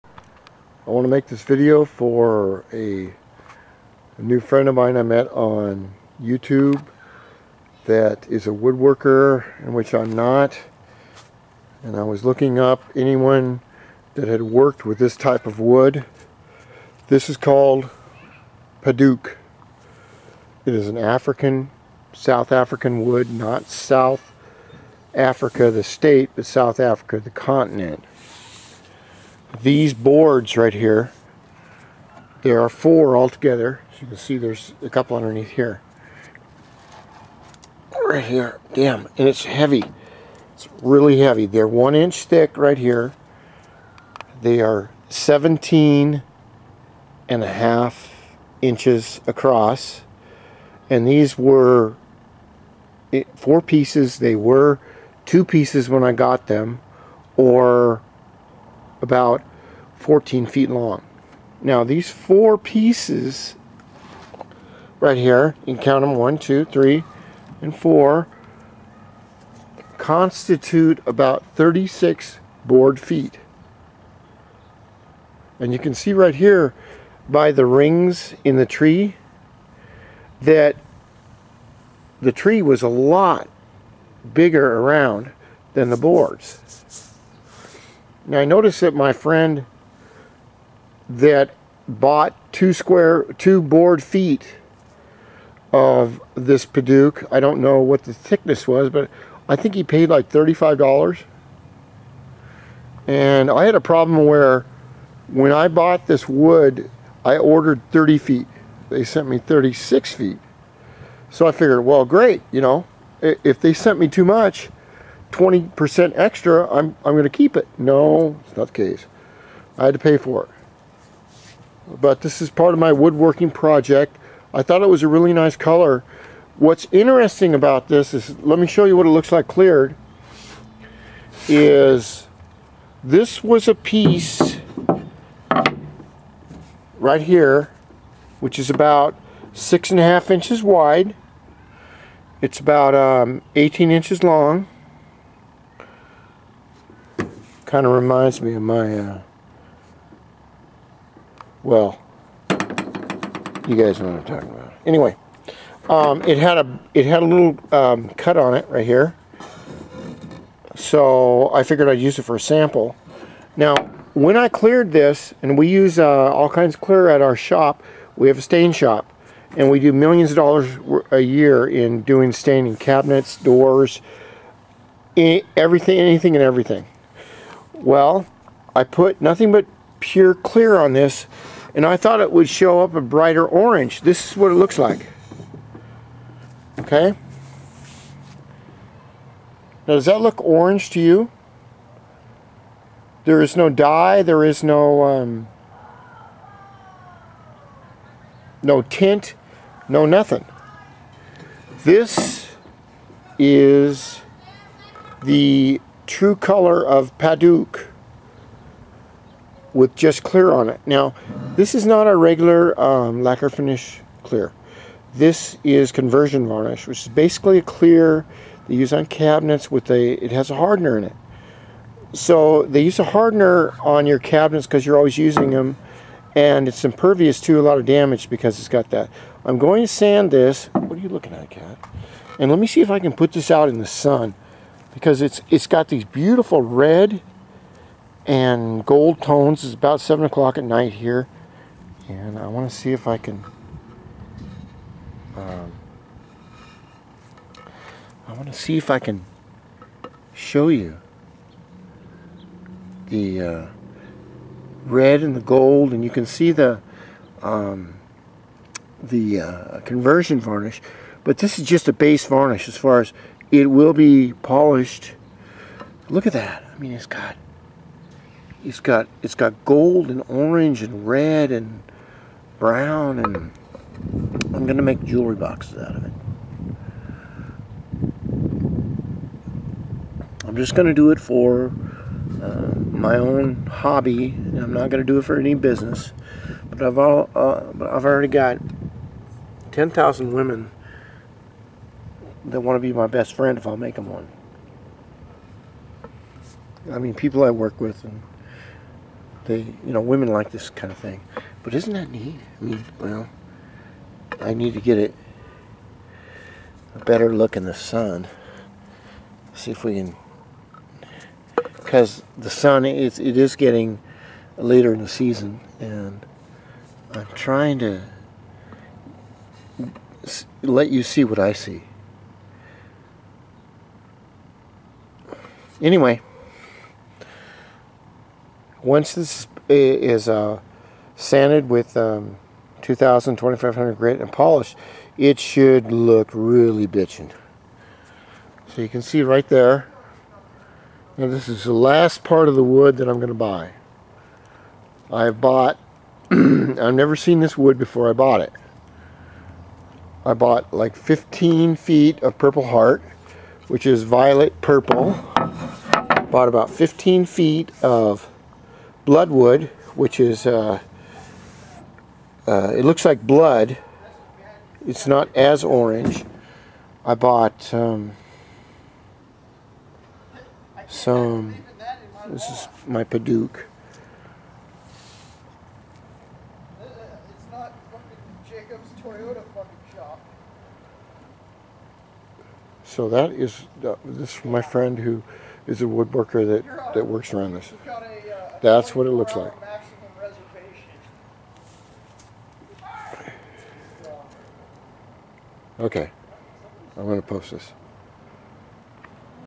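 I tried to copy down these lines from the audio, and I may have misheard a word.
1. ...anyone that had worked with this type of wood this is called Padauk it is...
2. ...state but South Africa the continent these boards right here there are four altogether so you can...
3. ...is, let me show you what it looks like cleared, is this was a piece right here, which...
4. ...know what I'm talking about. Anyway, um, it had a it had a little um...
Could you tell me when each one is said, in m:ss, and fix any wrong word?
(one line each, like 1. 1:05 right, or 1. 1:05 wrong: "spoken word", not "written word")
1. 0:12 right
2. 0:25 right
3. 2:08 right
4. 2:34 right.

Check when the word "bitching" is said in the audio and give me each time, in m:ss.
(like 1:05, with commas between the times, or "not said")
5:36.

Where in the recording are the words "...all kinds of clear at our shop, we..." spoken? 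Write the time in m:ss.
2:46.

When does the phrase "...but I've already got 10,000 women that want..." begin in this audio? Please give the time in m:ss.
4:47.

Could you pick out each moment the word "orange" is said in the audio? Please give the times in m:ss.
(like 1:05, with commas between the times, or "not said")
3:03, 3:10, 4:30, 6:05.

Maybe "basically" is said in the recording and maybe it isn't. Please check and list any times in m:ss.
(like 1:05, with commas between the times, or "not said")
3:37.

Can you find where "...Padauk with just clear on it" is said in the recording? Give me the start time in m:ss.
3:27.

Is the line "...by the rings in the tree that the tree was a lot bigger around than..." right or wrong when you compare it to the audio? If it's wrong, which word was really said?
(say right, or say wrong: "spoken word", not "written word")
right.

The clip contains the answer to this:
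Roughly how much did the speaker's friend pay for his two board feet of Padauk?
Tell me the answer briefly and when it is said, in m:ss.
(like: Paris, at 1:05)
$35, at 1:40.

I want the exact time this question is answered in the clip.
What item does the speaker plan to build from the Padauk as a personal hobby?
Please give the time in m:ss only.
4:35.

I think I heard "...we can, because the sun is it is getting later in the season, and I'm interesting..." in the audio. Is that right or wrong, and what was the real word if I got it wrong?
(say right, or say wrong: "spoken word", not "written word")
wrong: "trying", not "interesting".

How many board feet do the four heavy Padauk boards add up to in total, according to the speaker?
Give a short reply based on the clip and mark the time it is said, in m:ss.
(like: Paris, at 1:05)
36, at 1:11.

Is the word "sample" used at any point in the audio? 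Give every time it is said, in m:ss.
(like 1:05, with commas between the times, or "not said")
2:42.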